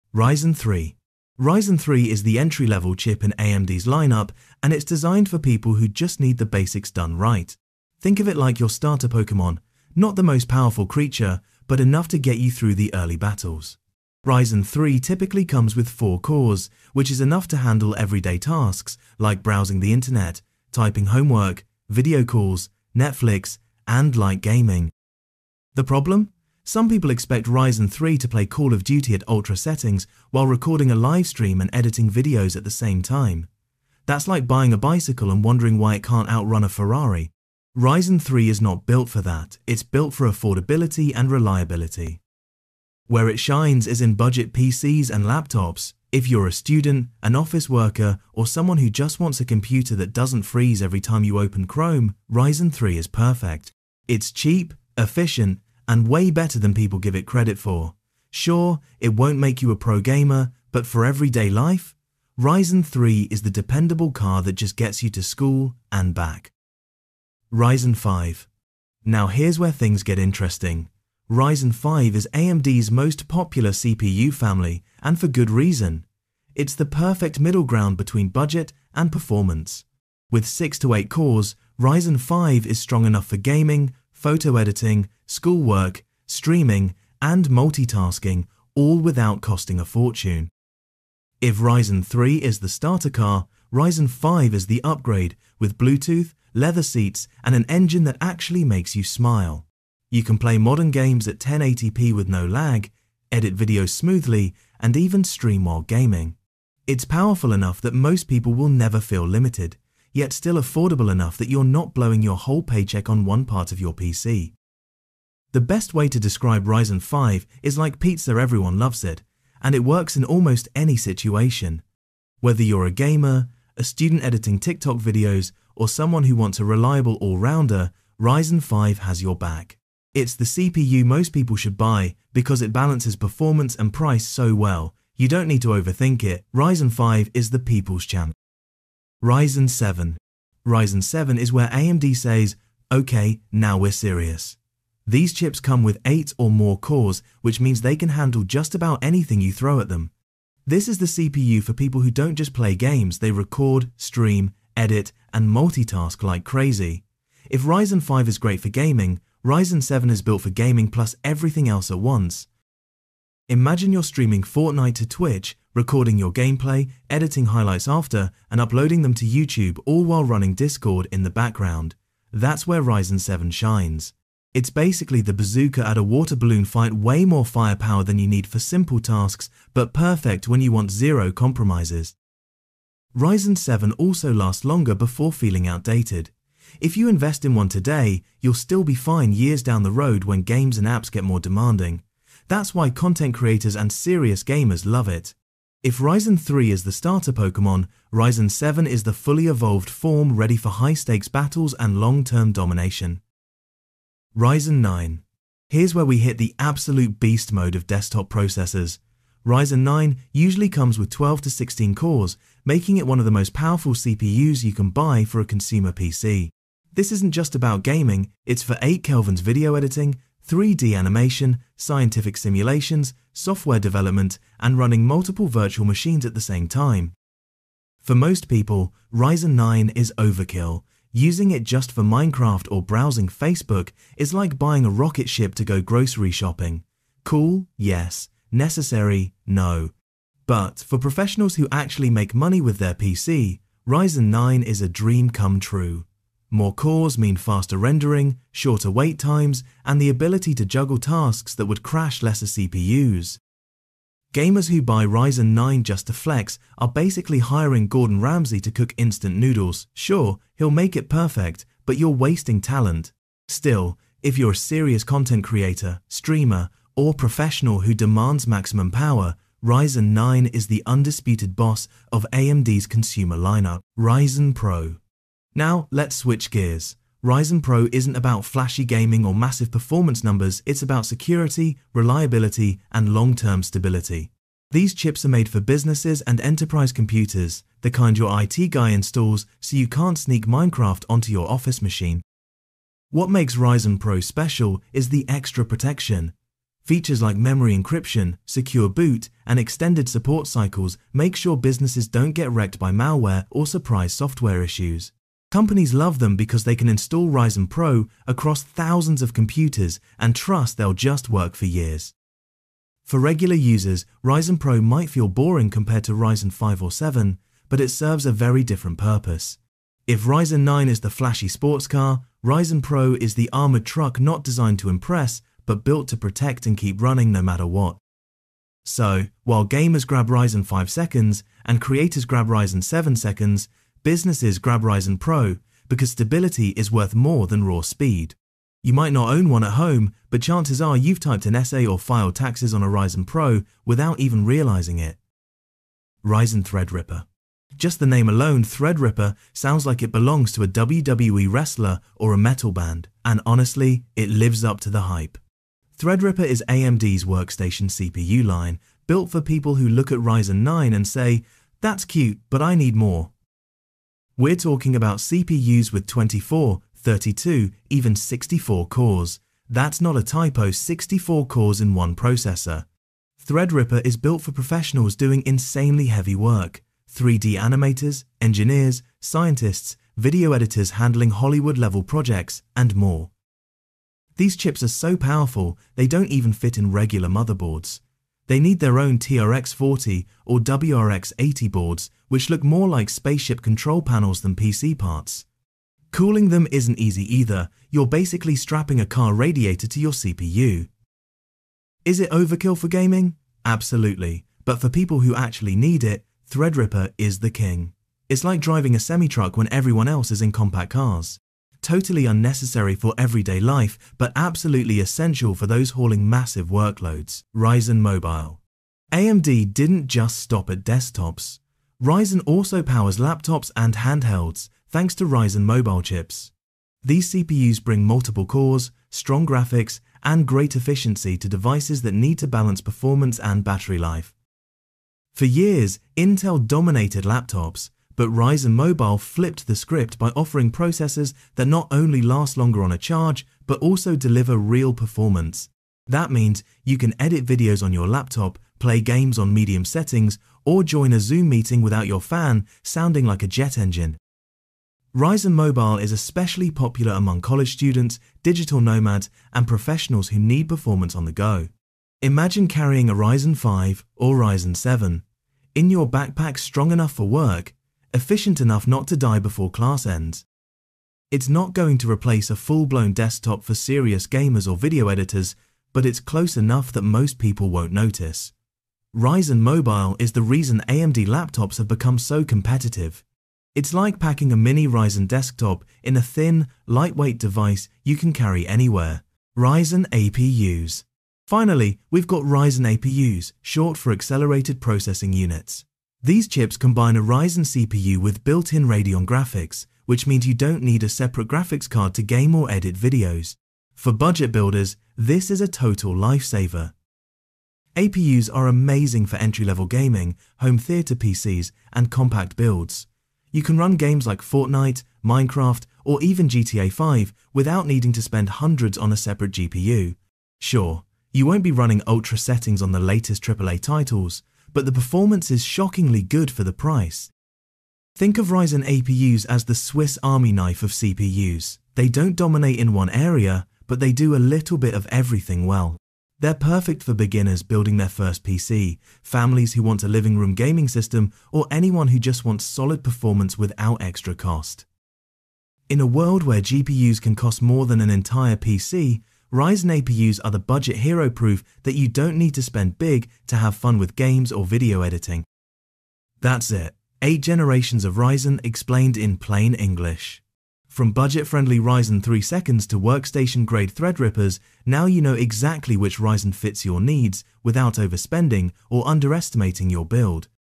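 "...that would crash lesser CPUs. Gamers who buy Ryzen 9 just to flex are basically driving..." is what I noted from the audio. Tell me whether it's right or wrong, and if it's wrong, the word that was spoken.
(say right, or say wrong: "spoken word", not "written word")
wrong: "hiring", not "driving".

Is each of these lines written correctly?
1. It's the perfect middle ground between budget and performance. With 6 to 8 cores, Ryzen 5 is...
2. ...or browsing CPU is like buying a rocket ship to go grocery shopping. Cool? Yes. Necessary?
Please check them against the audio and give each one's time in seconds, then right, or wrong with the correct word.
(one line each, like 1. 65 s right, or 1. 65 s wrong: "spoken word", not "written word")
1. 76 s right
2. 232 s wrong: "Facebook", not "CPU".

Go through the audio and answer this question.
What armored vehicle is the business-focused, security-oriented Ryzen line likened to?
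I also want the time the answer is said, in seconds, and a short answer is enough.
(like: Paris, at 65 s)
armored truck, at 323 s.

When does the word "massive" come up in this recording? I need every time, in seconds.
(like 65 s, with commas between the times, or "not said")
279 s, 416 s.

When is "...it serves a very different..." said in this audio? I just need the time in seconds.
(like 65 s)
317 s.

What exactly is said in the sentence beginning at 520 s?
Sure, you won't be running ultra settings on the latest AAA titles, but the performance is shockingly good for the price.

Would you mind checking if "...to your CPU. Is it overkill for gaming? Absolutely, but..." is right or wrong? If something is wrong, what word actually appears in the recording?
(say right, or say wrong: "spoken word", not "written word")
right.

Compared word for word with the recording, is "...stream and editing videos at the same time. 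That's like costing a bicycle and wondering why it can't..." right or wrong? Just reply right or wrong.
wrong.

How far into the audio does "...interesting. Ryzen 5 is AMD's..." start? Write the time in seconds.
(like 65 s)
70 s.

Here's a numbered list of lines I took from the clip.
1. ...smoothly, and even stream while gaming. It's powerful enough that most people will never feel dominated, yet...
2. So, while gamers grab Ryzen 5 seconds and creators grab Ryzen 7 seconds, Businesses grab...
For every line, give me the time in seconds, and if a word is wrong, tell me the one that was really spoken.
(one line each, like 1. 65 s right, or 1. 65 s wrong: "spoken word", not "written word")
1. 103 s wrong: "limited", not "dominated"
2. 328 s right.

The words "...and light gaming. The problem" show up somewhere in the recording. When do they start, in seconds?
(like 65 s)
23 s.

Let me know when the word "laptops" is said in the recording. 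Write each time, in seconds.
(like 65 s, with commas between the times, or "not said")
45 s, 423 s, 437 s, 448 s, 481 s.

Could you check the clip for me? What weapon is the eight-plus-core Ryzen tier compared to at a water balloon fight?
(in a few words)
bazooka.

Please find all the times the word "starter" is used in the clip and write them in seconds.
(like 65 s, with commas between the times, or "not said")
8 s, 92 s, 196 s.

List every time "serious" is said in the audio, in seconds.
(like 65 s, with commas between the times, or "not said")
143 s, 193 s, 264 s, 473 s.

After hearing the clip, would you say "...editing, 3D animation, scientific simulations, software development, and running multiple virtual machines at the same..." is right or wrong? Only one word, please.
right.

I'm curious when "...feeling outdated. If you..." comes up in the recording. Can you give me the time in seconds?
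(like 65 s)
185 s.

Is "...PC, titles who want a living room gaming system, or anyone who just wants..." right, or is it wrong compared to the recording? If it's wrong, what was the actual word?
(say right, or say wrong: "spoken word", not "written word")
wrong: "families", not "titles".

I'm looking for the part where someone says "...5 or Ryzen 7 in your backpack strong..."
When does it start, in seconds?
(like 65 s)
463 s.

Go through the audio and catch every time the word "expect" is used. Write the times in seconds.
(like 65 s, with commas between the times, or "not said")
27 s.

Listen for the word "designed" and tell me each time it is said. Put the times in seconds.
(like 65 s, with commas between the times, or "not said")
4 s, 324 s.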